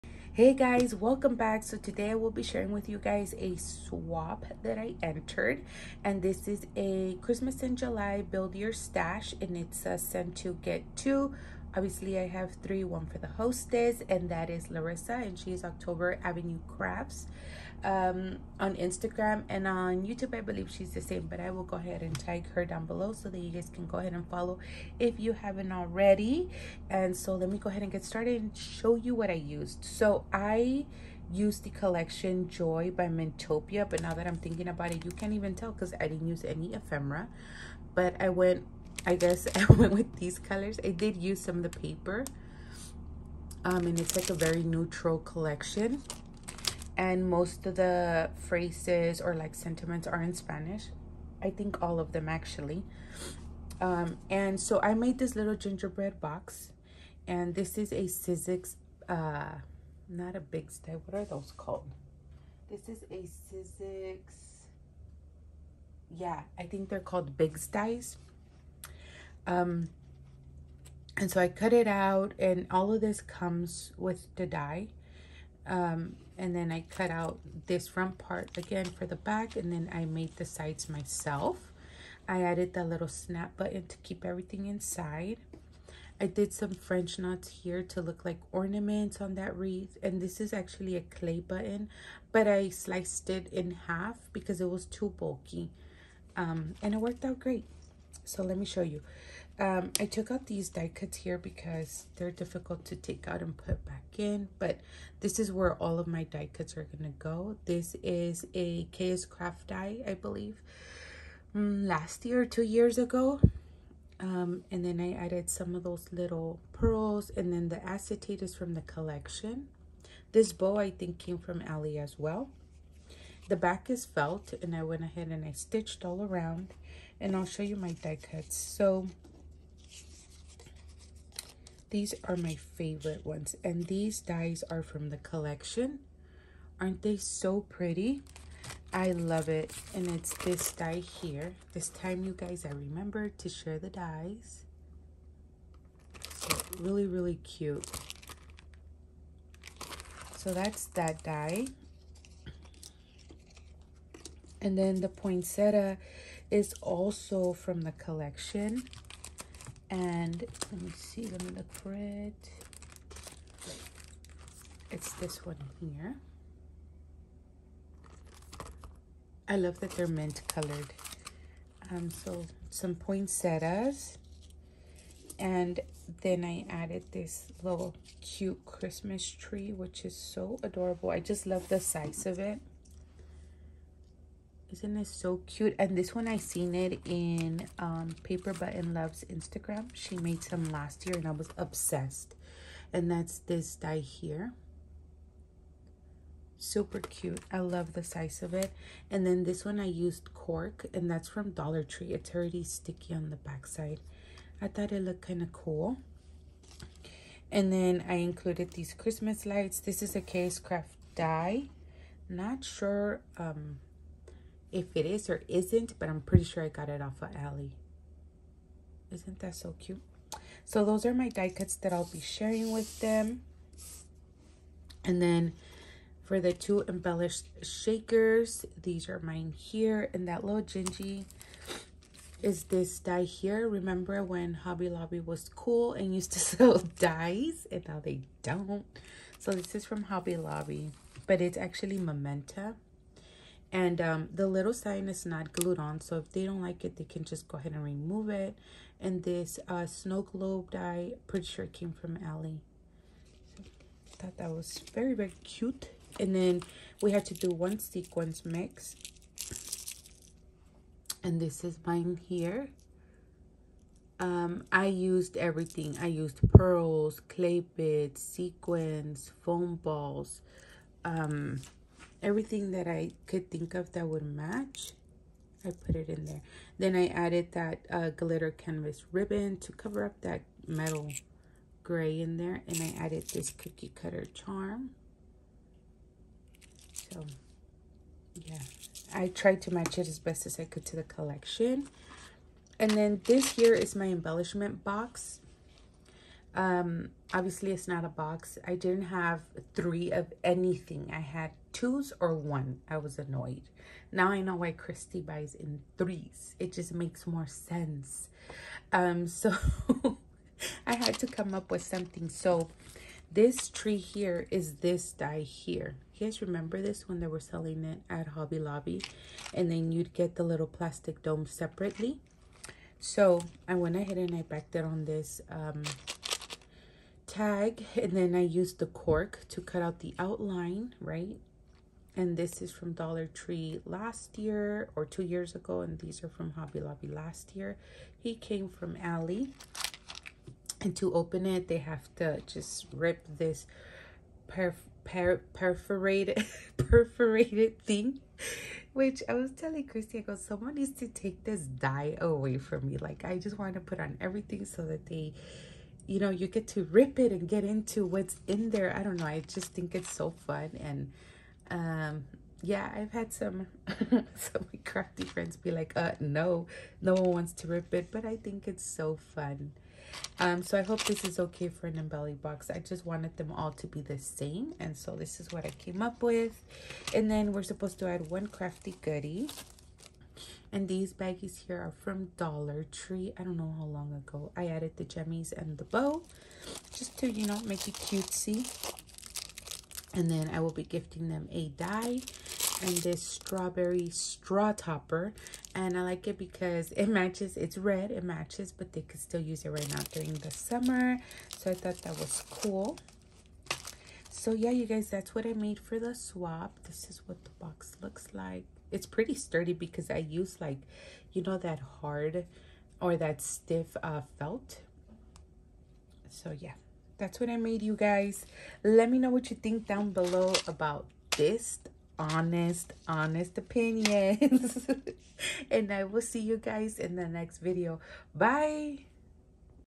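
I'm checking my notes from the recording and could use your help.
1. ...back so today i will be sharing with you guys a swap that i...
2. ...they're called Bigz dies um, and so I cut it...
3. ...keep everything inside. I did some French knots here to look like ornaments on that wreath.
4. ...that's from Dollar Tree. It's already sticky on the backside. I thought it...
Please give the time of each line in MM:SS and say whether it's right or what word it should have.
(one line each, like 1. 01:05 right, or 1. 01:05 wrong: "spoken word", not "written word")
1. 00:01 right
2. 01:06 right
3. 01:23 right
4. 03:21 right.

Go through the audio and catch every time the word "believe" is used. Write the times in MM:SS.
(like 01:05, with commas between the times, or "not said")
00:20, 01:50.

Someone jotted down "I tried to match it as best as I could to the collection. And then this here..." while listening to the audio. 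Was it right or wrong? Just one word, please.
right.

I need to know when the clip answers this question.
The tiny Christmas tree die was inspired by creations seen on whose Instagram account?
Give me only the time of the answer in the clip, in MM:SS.
03:08.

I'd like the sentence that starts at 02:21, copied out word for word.
This time you guys I remember to share the dies.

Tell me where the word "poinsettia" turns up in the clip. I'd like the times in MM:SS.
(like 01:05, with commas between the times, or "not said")
02:35, 02:52.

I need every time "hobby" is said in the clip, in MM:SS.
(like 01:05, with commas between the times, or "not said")
03:54, 04:00, 05:18, 05:36.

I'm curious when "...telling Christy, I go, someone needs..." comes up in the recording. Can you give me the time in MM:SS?
05:49.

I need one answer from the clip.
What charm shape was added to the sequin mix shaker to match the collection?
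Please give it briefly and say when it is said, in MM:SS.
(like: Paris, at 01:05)
Cookie cutter, at 04:43.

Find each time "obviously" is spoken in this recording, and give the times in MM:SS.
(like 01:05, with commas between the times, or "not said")
00:11, 04:57.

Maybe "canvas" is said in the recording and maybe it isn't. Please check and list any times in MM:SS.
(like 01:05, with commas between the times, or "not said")
04:38.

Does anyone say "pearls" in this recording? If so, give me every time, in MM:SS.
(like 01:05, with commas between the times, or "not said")
01:56, 04:26.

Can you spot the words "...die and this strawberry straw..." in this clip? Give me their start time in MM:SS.
06:31.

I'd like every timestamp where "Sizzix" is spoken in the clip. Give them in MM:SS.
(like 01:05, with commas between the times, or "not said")
00:58, 01:03.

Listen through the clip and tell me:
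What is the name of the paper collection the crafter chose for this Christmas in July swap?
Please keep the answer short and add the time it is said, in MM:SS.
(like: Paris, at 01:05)
Joy by Mentopia, at 00:32.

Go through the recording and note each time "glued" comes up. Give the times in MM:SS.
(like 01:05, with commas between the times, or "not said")
04:05.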